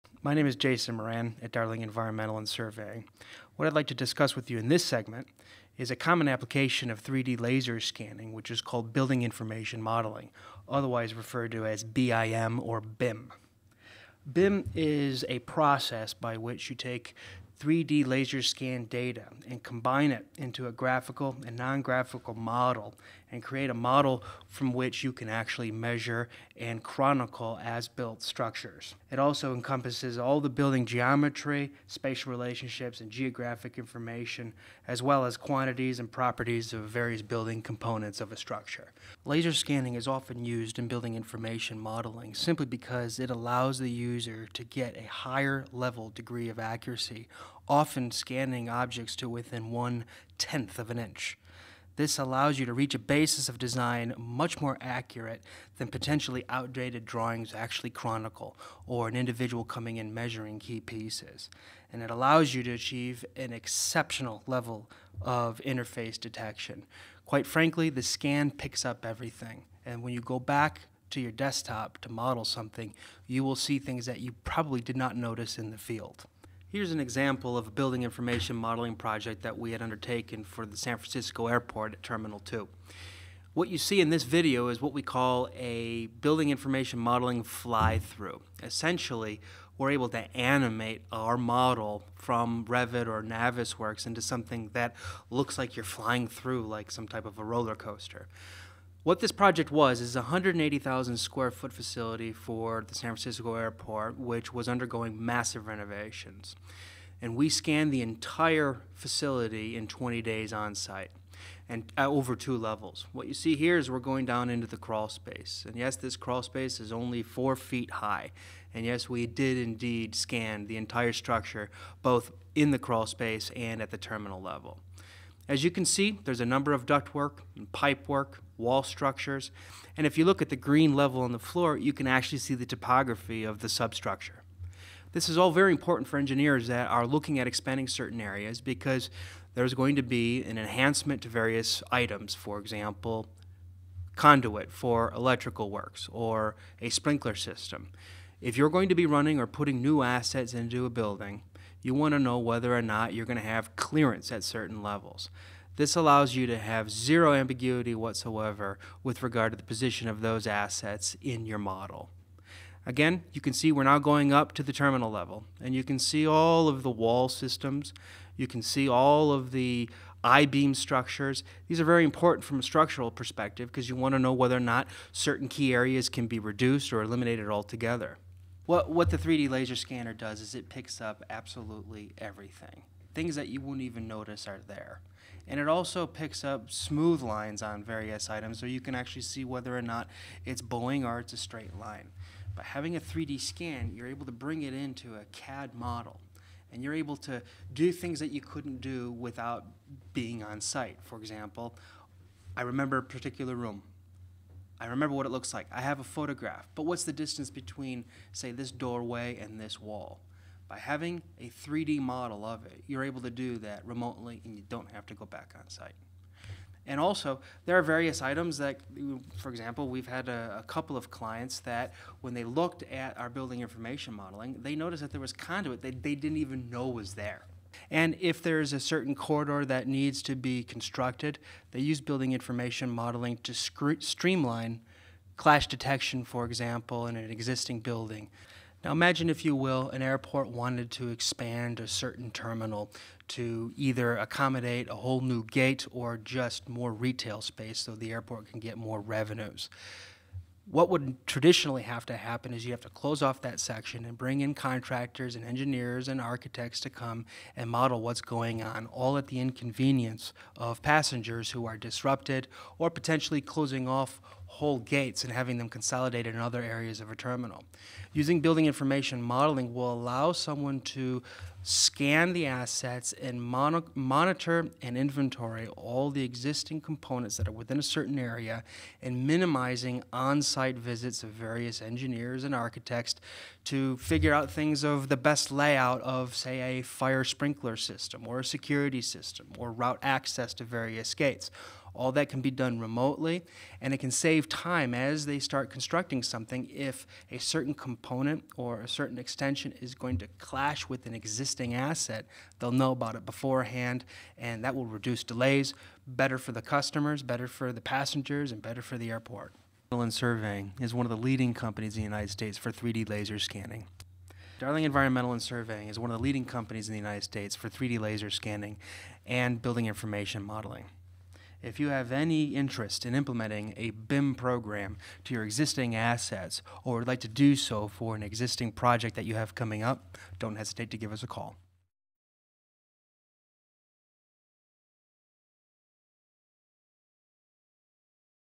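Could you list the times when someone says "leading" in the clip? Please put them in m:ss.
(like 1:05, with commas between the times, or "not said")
5:11, 5:16.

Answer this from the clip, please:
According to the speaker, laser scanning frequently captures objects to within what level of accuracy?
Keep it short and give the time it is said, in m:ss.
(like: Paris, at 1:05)
one tenth of an inch, at 0:49.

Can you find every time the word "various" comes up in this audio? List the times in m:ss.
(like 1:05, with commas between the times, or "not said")
0:36, 2:21, 3:07, 3:37, 4:41, 4:50.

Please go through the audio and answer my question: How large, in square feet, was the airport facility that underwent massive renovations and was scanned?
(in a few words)
180,000 square feet.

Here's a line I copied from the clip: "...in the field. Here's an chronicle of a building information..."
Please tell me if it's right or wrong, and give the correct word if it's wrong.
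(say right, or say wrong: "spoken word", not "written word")
wrong: "example", not "chronicle".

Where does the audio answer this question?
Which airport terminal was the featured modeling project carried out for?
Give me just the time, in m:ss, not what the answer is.
1:22.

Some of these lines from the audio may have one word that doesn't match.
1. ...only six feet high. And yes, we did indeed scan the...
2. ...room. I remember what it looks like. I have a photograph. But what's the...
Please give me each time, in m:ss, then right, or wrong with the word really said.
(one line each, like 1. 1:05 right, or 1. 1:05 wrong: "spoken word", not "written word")
1. 1:56 wrong: "four", not "six"
2. 3:23 right.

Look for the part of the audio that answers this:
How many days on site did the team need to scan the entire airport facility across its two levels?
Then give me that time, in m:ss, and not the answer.
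1:49.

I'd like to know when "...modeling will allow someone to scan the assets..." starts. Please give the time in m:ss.
4:29.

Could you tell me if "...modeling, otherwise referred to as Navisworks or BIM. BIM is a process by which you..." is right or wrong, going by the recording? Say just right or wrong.
wrong.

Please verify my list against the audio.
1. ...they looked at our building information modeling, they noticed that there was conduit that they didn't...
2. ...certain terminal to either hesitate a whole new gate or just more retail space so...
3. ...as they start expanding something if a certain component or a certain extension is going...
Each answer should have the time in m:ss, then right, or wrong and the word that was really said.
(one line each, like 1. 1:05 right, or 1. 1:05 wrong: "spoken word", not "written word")
1. 3:42 right
2. 4:01 wrong: "accommodate", not "hesitate"
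3. 4:54 wrong: "constructing", not "expanding".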